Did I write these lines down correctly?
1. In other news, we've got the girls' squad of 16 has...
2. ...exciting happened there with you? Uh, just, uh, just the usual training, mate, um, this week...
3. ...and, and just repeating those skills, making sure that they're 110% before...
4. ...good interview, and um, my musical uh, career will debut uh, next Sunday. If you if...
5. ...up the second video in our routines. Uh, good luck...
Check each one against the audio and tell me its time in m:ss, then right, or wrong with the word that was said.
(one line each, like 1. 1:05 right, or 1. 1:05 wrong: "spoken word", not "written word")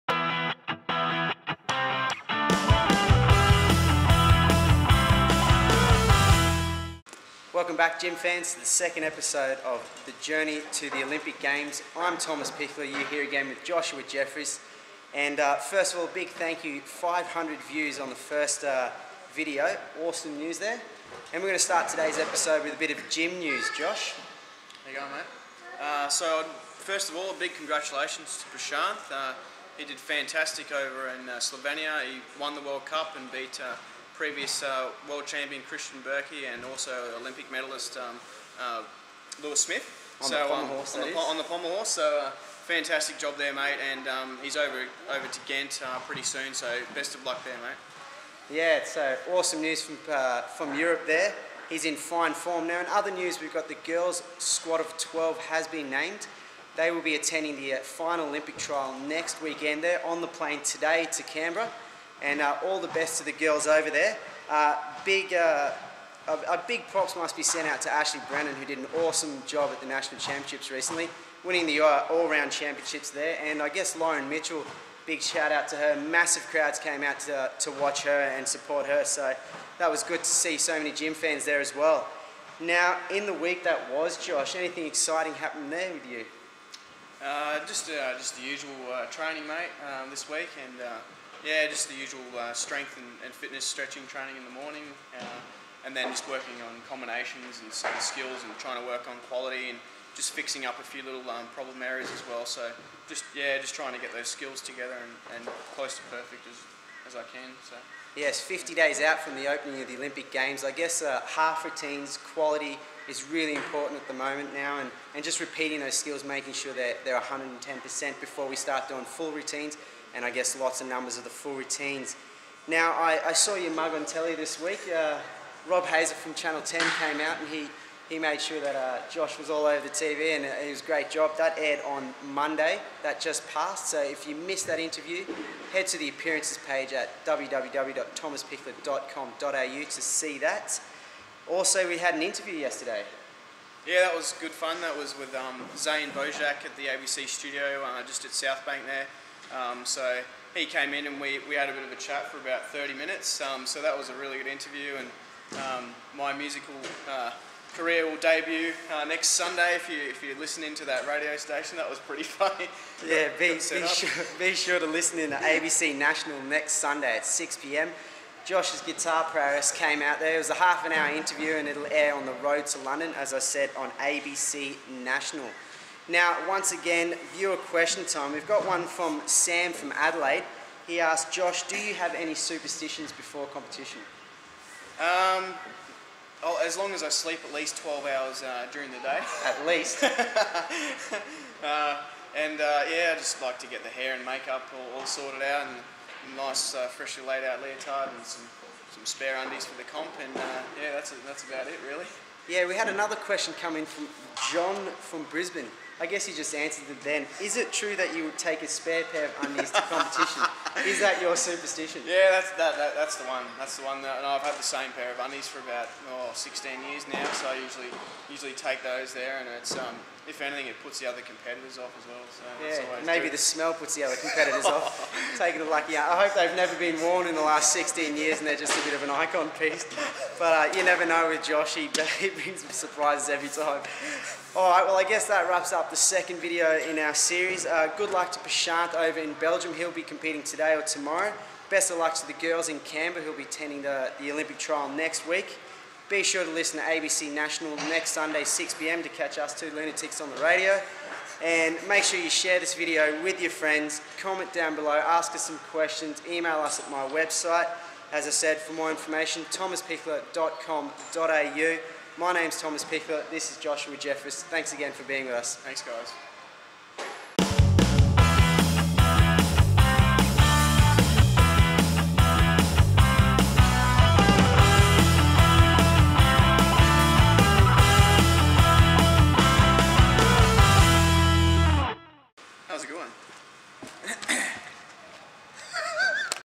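1. 0:52 wrong: "12", not "16"
2. 1:24 right
3. 1:54 right
4. 2:34 right
5. 3:55 wrong: "series", not "routines".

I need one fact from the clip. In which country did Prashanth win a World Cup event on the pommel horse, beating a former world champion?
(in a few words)
Slovenia.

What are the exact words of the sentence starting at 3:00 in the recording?
He asked, Josh, do you have any superstitions before competition?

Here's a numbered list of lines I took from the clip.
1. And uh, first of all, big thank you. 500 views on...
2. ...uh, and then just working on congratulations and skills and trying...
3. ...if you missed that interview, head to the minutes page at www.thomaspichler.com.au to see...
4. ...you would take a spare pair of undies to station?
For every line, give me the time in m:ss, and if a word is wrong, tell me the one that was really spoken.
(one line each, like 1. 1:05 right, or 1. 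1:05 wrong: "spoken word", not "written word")
1. 0:15 right
2. 1:35 wrong: "combinations", not "congratulations"
3. 2:14 wrong: "appearances", not "minutes"
4. 3:28 wrong: "competition", not "station".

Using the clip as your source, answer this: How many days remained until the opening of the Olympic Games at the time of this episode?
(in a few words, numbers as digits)
50.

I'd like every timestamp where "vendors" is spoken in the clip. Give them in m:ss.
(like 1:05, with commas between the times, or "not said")
not said.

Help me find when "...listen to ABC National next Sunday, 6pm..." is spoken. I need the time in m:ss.
4:06.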